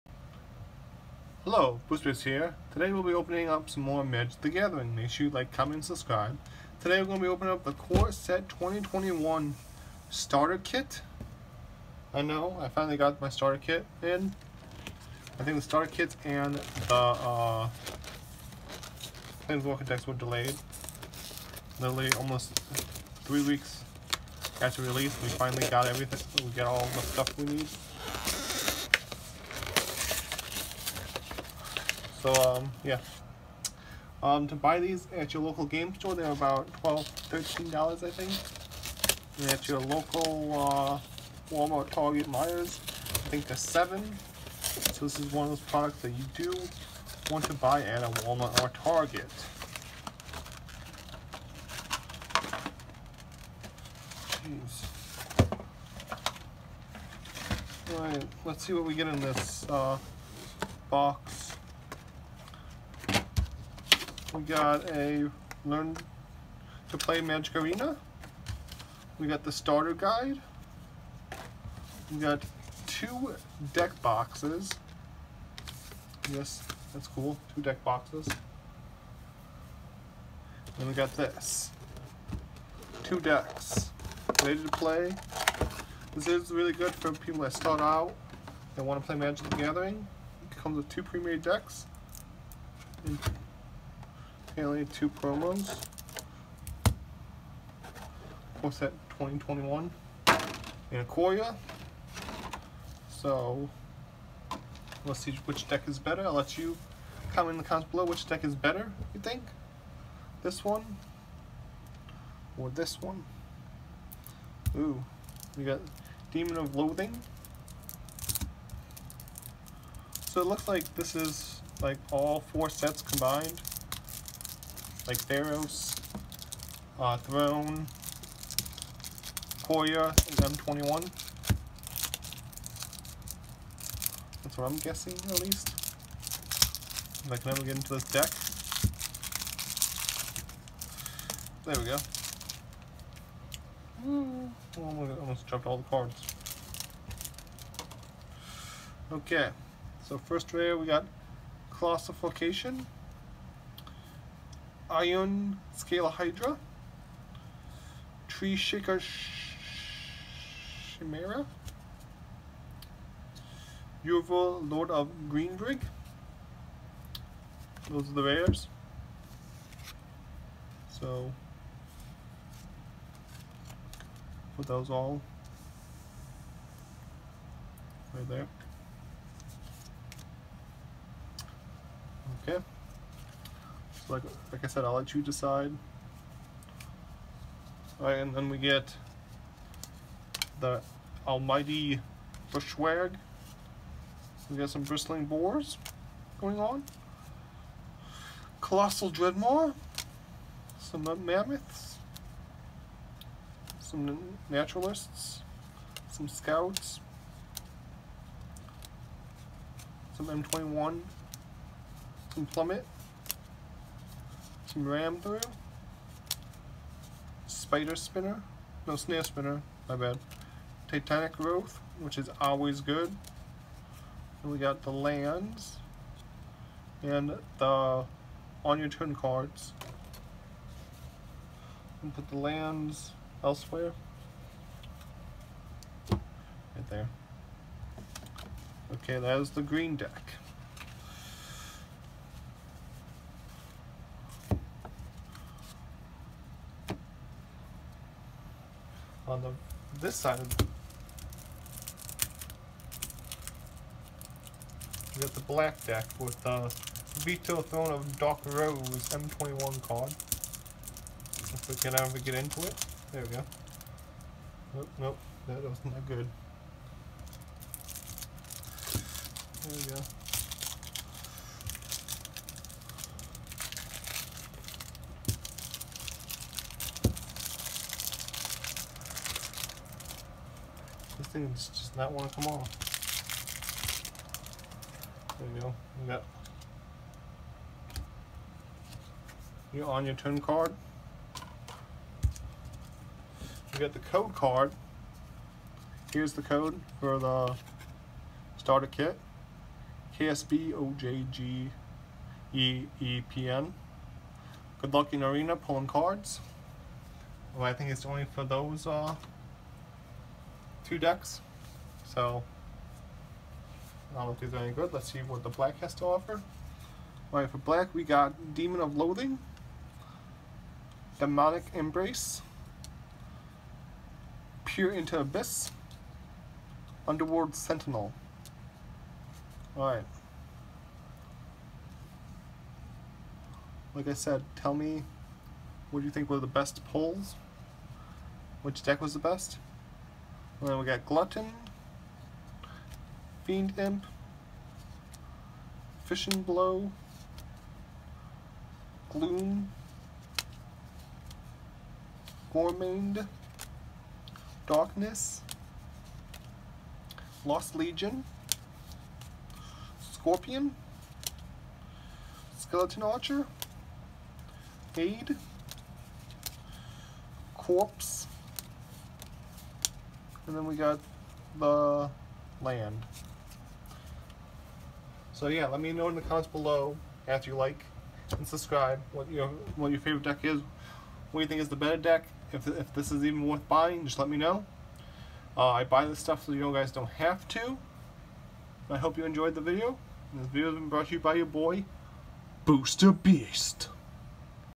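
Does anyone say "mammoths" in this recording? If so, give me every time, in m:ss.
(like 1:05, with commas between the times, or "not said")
3:21.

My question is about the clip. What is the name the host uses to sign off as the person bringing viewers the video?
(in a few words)
Booster Beast.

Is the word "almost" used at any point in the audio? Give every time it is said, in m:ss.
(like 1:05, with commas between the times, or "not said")
0:22, 2:25.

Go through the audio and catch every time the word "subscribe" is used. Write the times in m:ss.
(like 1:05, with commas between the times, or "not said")
0:05, 6:18.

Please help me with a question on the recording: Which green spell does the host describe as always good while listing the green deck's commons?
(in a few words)
Titanic Growth.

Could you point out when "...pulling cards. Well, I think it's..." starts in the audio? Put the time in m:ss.
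5:05.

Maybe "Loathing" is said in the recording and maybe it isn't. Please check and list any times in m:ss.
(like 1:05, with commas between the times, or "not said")
1:56, 5:18.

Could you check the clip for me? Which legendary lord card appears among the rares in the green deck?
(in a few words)
Yorvo, Lord of Garenbrig.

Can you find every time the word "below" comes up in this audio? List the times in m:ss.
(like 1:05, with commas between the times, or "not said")
1:47, 6:16.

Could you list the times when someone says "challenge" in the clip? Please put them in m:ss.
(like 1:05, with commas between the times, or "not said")
not said.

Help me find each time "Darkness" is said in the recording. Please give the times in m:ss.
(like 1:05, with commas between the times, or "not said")
5:54.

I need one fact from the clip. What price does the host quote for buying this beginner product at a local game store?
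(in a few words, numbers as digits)
$12, $13.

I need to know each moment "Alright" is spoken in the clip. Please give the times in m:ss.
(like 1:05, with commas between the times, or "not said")
0:57, 3:07, 5:17, 5:29.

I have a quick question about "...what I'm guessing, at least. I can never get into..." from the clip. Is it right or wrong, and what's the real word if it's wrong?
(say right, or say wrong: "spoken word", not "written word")
right.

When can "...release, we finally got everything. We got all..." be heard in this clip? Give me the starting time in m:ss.
0:24.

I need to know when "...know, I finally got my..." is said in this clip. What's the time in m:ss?
0:12.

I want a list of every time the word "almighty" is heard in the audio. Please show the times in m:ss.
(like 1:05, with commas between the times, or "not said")
3:11.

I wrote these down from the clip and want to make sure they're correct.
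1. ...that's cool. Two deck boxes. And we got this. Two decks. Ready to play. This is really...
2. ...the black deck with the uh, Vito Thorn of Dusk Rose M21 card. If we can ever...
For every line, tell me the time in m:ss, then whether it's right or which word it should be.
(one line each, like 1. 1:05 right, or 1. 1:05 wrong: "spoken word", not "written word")
1. 1:16 right
2. 4:15 right.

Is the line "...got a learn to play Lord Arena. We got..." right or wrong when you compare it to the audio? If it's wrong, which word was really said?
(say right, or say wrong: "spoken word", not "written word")
wrong: "Magic", not "Lord".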